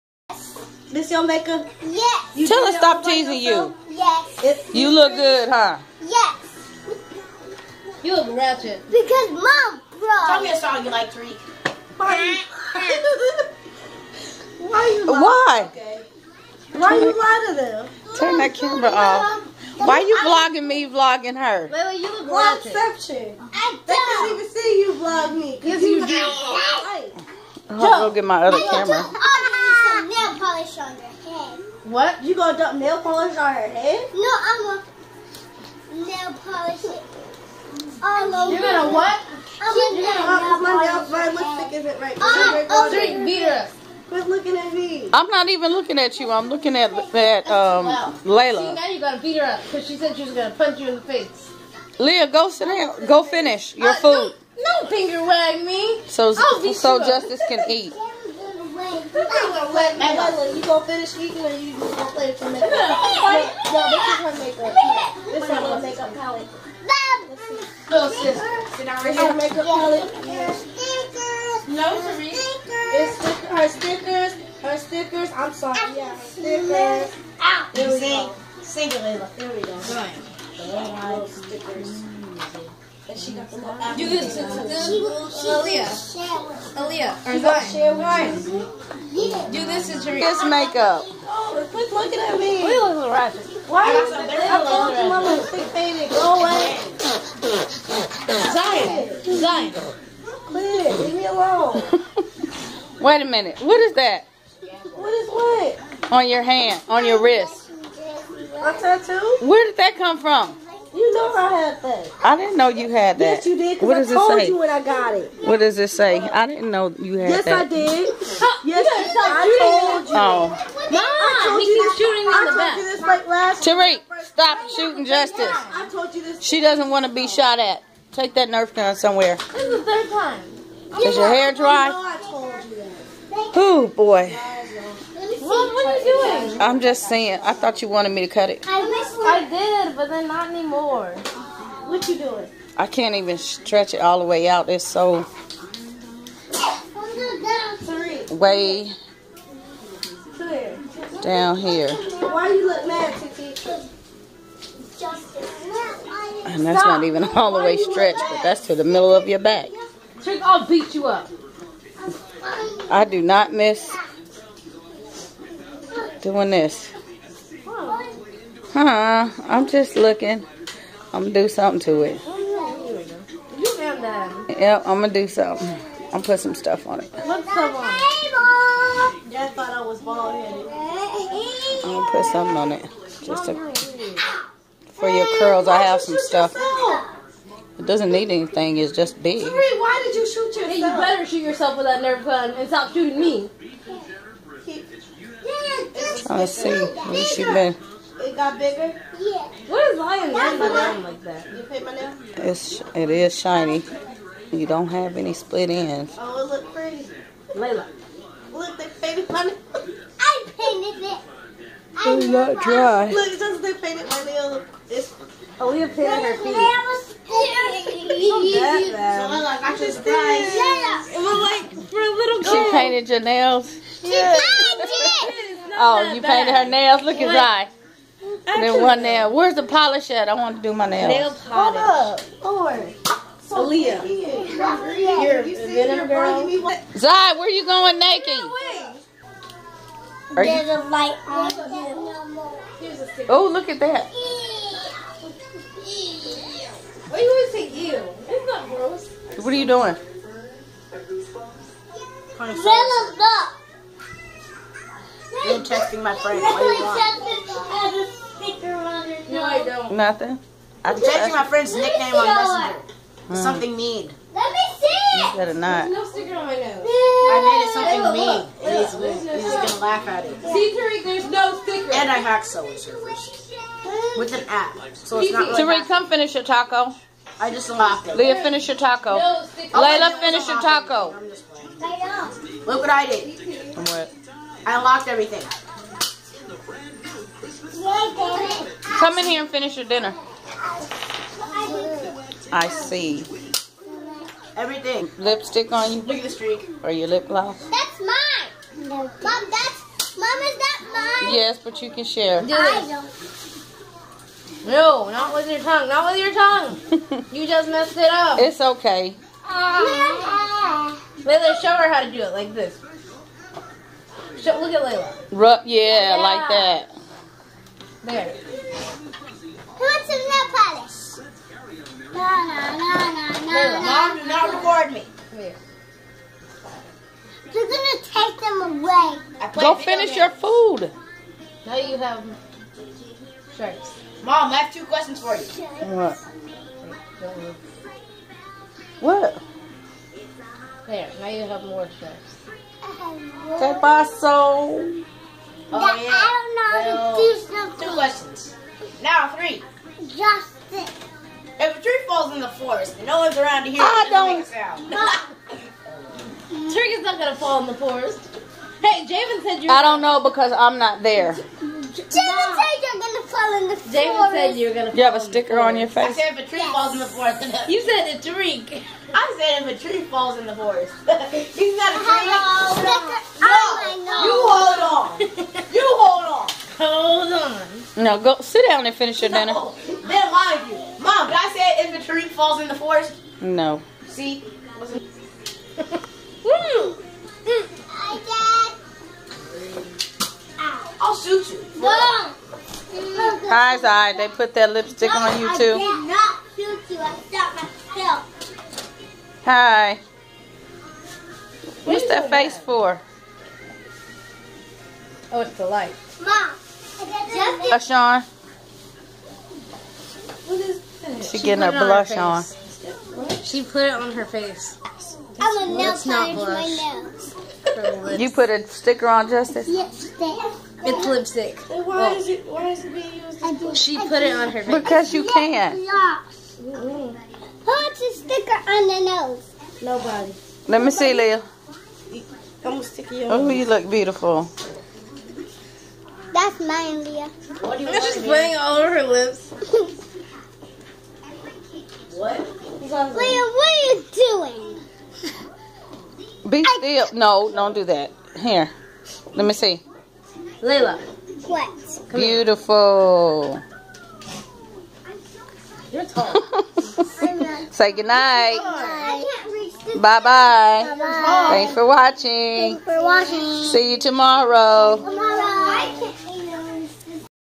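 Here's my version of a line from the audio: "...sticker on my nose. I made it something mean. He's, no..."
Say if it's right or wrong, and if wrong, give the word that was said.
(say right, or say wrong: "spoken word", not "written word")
right.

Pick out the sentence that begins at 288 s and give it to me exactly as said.
Come in here and finish your dinner.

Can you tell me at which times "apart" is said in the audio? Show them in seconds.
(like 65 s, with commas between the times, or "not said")
not said.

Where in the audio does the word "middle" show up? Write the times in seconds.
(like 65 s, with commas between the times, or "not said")
158 s.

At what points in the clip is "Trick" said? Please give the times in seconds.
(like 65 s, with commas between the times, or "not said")
160 s.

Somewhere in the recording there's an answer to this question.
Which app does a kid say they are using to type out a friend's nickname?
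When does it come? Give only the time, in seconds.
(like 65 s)
262 s.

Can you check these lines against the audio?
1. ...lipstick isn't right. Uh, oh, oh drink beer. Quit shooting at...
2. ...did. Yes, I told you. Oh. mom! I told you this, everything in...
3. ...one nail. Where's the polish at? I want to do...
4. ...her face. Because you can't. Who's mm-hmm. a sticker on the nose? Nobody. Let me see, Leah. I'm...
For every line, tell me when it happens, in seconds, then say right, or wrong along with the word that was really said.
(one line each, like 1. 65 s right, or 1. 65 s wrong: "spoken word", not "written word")
1. 41 s wrong: "looking", not "shooting"
2. 117 s wrong: "shooting", not "everything"
3. 228 s right
4. 424 s right.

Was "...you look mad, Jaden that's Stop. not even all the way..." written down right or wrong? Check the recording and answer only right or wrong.
wrong.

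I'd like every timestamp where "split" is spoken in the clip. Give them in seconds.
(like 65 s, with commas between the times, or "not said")
205 s.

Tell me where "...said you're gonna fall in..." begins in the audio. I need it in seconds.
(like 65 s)
362 s.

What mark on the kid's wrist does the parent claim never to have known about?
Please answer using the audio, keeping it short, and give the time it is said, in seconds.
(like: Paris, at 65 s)
A tattoo, at 108 s.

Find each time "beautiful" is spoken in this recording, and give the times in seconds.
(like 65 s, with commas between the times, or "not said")
433 s, 452 s.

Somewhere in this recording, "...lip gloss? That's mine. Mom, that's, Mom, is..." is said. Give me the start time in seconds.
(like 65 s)
297 s.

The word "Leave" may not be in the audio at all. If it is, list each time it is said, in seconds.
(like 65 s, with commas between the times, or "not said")
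100 s.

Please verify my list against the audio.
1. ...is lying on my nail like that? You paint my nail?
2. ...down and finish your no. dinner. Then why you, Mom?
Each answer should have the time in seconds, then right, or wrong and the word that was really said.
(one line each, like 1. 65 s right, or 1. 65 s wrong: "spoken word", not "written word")
1. 199 s right
2. 378 s right.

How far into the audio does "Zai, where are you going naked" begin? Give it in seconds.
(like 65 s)
236 s.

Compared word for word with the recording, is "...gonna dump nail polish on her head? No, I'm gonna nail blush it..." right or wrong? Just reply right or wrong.
wrong.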